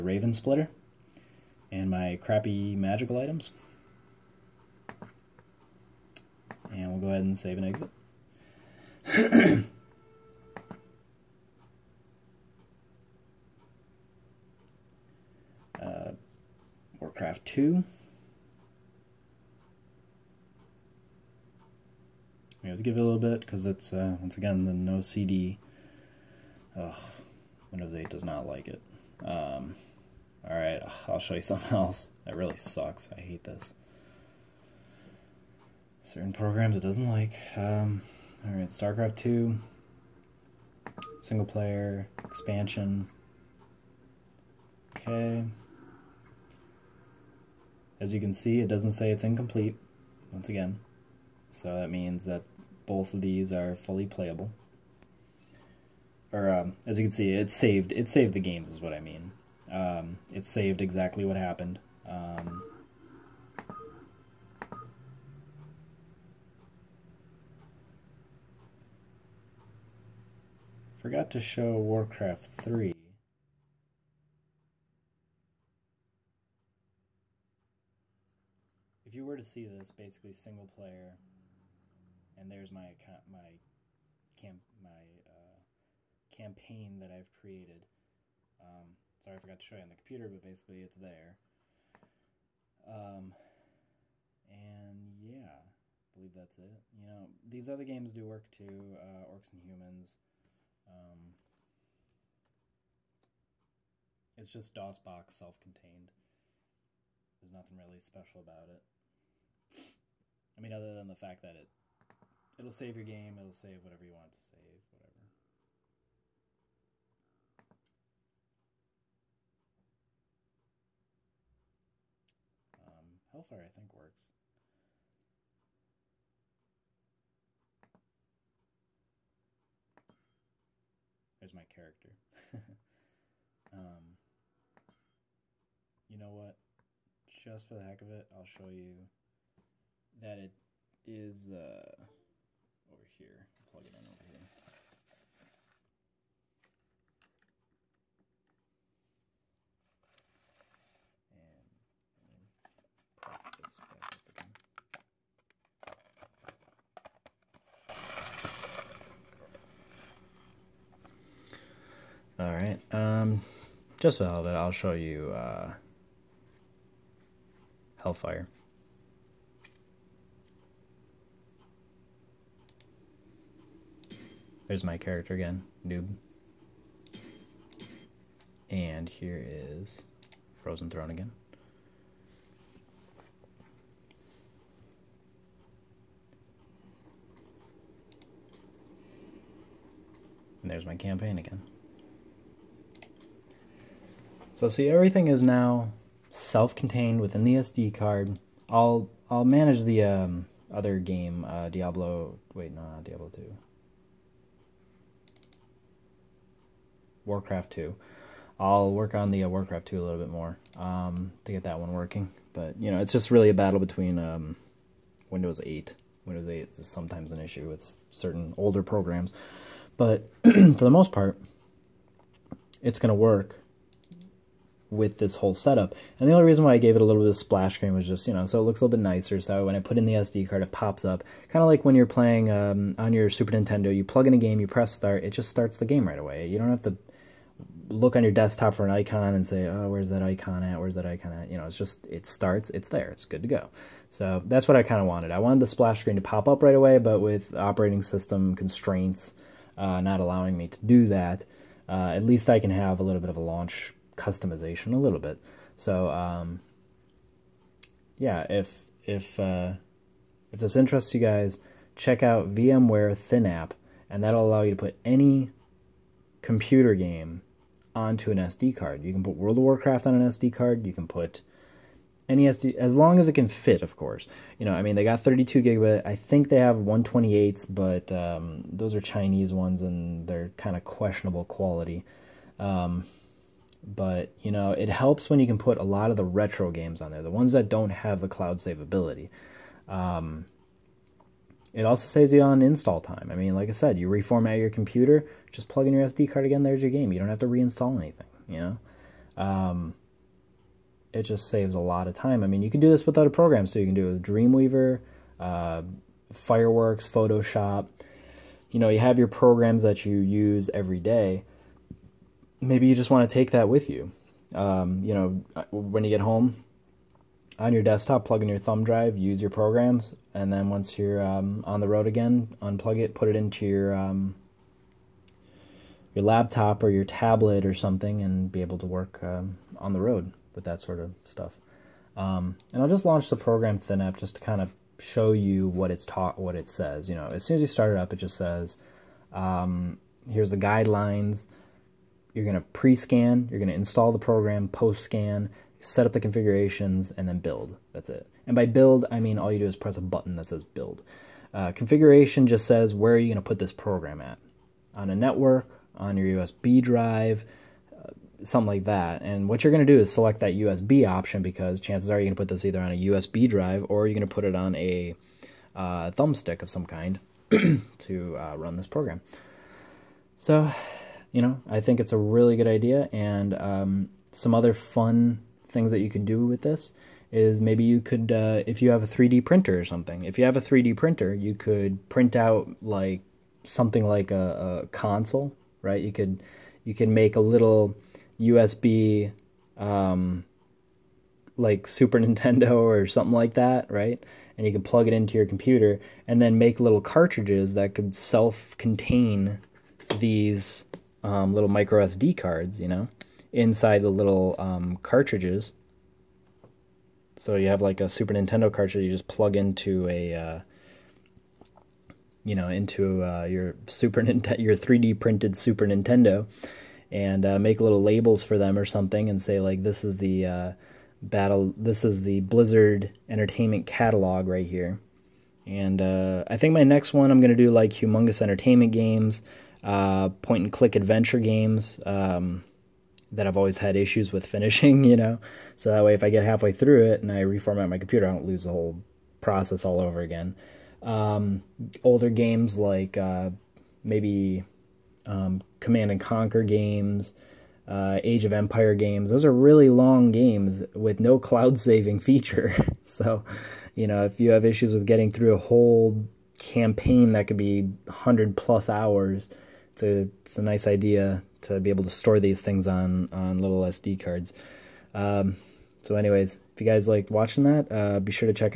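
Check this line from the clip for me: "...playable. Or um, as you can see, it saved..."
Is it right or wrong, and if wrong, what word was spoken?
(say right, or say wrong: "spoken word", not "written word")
right.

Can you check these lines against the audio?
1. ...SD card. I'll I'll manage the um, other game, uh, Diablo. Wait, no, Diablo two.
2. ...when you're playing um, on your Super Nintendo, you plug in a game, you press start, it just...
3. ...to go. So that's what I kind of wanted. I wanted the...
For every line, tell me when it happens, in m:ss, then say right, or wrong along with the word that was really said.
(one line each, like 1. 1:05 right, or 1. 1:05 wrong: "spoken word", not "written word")
1. 3:17 right
2. 3:51 right
3. 4:03 right.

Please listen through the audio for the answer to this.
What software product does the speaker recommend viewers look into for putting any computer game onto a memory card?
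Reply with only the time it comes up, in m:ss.
4:22.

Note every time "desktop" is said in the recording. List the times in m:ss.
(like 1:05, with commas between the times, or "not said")
3:58, 5:17.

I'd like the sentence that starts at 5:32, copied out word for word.
Um, and I'll just launch the program ThinApp just to kind of show you what it's taught, what it says.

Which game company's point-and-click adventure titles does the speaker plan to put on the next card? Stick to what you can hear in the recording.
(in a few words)
Humongous Entertainment.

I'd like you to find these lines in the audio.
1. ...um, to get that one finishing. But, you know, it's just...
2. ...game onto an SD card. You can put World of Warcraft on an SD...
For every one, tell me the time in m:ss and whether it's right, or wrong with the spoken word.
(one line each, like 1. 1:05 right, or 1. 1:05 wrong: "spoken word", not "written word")
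1. 3:30 wrong: "working", not "finishing"
2. 4:26 right.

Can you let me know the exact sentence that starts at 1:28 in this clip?
Um, sorry, I forgot to show you on the computer, but basically it's there.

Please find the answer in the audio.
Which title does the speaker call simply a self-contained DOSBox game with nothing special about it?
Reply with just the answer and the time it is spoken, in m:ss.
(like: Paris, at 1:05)
Orcs and Humans, at 1:39.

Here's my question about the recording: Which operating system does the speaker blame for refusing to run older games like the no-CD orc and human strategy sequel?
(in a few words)
Windows 8.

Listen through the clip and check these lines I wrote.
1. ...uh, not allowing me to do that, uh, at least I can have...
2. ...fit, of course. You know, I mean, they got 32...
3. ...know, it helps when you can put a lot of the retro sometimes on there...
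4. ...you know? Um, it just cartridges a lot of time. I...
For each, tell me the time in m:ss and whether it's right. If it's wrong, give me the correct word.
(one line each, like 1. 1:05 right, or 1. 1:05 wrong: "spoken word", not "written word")
1. 4:09 right
2. 4:33 right
3. 4:44 wrong: "games", not "sometimes"
4. 4:58 wrong: "saves", not "cartridges".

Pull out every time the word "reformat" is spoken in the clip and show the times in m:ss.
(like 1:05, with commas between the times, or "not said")
4:54, 7:17.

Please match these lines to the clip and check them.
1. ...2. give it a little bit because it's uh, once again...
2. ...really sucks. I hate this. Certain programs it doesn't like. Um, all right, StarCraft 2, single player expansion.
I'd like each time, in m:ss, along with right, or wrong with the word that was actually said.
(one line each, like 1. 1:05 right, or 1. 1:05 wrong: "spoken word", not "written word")
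1. 0:17 right
2. 0:32 right.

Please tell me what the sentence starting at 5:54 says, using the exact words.
On a network, on your USB drive, uh, something like that.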